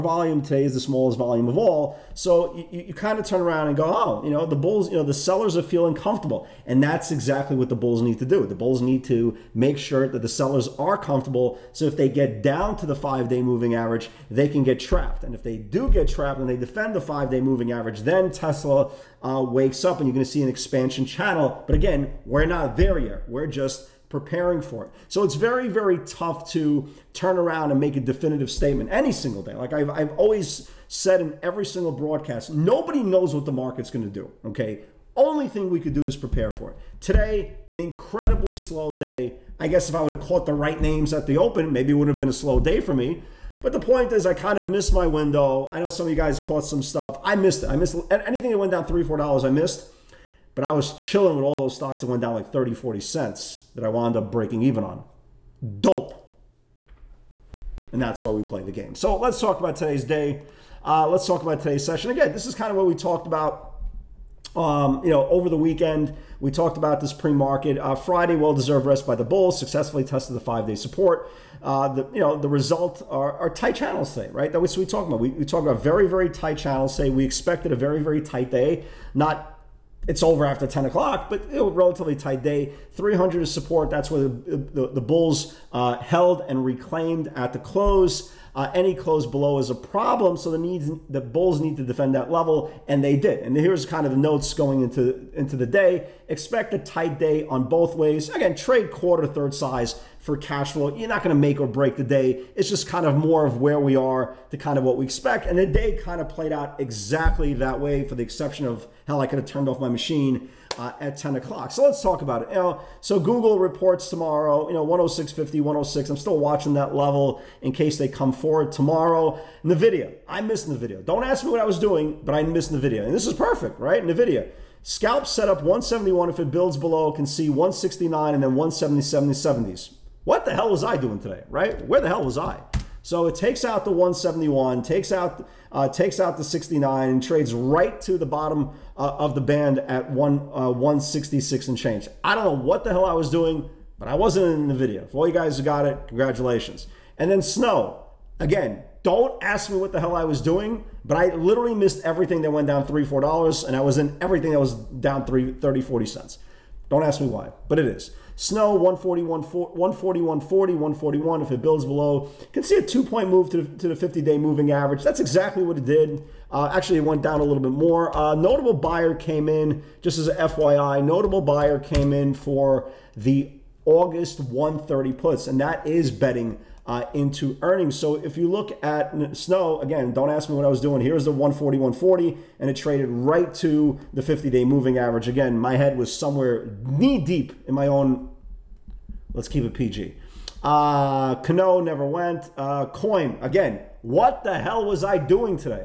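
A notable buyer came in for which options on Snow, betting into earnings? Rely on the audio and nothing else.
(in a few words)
August 130 puts.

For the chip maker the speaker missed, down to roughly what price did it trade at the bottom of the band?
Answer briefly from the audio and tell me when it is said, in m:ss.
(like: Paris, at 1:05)
166, at 2:20.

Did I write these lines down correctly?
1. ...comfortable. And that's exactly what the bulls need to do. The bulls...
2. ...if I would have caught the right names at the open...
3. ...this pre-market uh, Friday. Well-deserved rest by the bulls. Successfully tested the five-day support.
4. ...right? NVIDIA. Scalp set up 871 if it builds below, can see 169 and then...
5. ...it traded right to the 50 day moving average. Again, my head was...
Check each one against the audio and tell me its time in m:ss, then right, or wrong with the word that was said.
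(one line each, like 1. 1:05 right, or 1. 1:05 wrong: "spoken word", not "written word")
1. 0:05 right
2. 0:39 right
3. 1:07 right
4. 2:03 wrong: "171", not "871"
5. 3:02 right.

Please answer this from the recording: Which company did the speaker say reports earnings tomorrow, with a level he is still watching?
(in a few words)
Google.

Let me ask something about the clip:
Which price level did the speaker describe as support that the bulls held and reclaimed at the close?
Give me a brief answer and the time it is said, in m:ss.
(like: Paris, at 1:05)
300, at 1:22.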